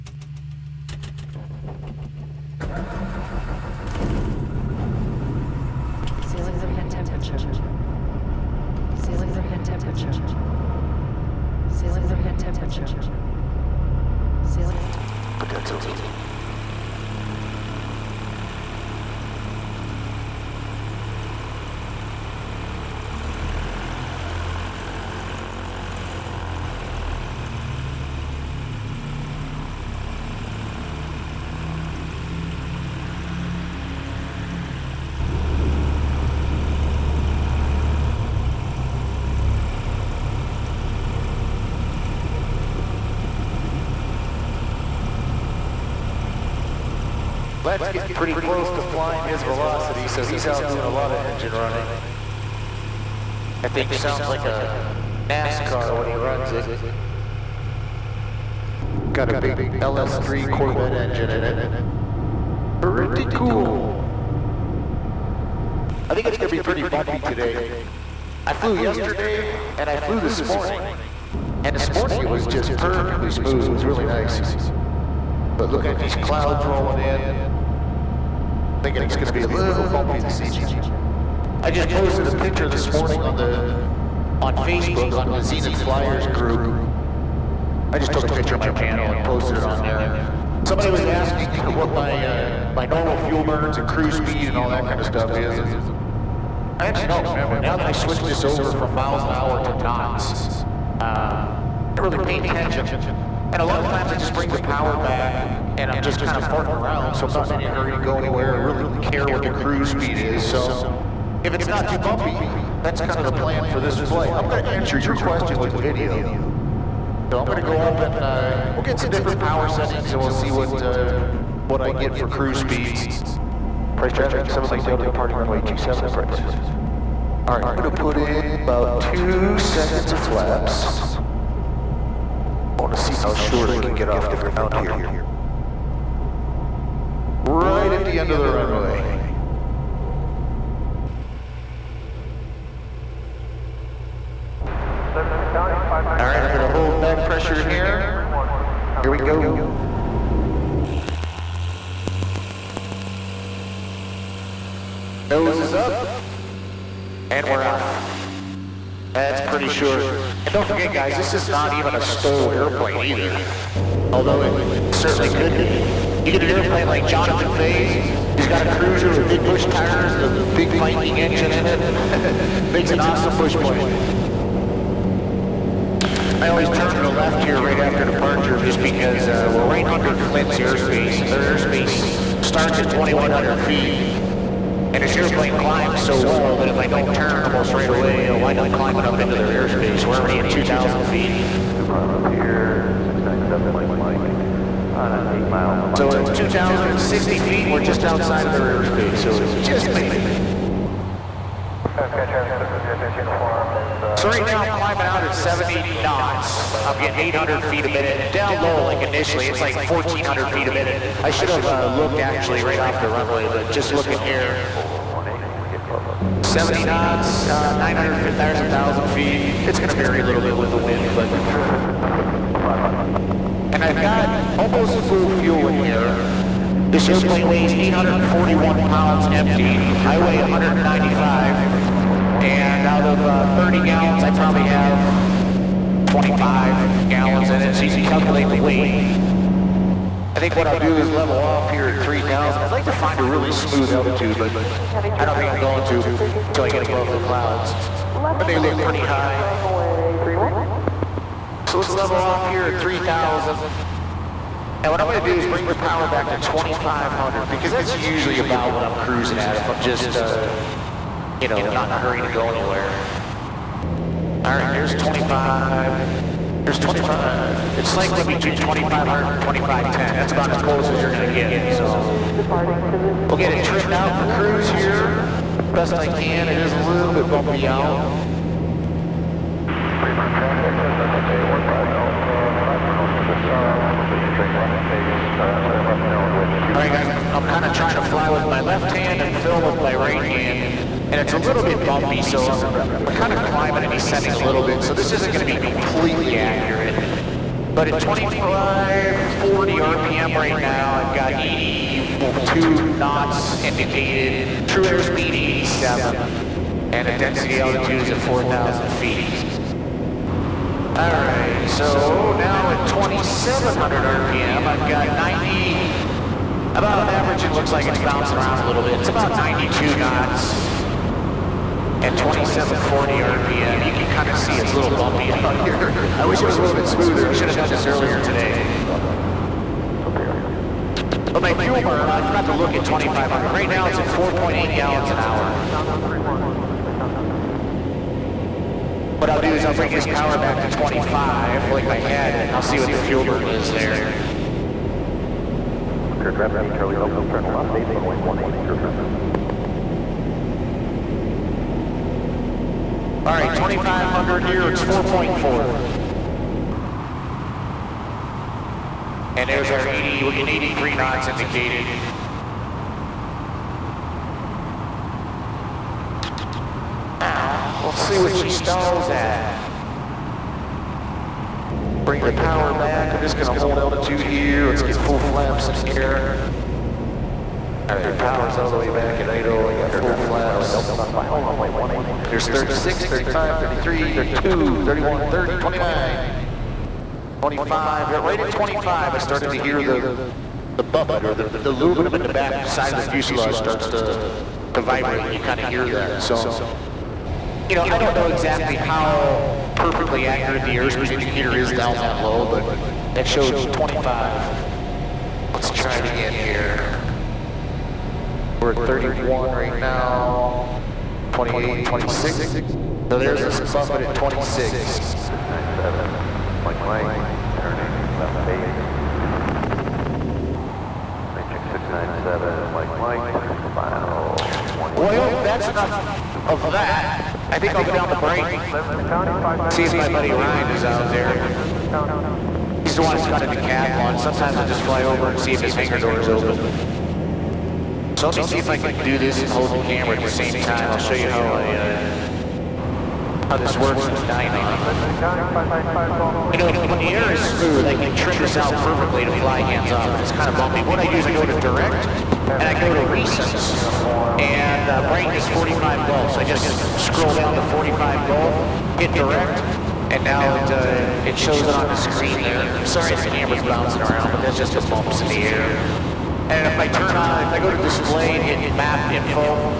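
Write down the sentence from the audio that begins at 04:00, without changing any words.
I think what I'll do is level off here at 3,000.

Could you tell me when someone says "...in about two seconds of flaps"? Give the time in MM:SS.
02:08.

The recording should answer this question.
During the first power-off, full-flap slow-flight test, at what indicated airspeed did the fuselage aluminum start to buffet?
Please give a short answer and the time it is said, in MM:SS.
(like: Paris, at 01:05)
25 knots, at 06:28.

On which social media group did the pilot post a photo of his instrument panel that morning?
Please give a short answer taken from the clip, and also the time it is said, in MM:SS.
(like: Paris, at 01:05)
Zenith Flyers group, at 01:25.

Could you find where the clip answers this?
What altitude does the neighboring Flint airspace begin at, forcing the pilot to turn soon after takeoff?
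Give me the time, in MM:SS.
03:02.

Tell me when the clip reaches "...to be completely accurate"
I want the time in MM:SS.
04:55.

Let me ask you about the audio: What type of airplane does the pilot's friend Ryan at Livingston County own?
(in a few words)
Decathlon.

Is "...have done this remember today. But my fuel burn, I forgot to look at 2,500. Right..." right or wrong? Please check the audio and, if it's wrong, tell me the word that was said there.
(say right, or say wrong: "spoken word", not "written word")
wrong: "earlier", not "remember".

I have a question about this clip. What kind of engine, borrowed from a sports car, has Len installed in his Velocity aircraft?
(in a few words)
LS3 Corvette engine.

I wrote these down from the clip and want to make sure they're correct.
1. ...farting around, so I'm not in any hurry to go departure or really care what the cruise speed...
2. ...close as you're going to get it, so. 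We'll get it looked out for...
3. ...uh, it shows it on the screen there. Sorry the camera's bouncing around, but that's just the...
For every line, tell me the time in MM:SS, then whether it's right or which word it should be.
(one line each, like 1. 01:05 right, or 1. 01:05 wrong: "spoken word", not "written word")
1. 01:46 wrong: "anywhere", not "departure"
2. 04:30 wrong: "trimmed", not "looked"
3. 07:40 right.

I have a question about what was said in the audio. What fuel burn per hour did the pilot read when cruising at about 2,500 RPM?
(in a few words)
4.4 gallons per hour.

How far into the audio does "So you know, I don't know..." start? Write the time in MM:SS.
06:36.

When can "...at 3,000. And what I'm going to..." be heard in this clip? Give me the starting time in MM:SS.
04:12.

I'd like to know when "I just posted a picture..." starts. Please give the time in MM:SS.
01:21.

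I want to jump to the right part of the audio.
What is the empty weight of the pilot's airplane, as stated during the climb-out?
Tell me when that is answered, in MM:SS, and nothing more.
03:47.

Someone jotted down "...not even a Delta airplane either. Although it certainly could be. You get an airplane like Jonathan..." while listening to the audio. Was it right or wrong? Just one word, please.
wrong.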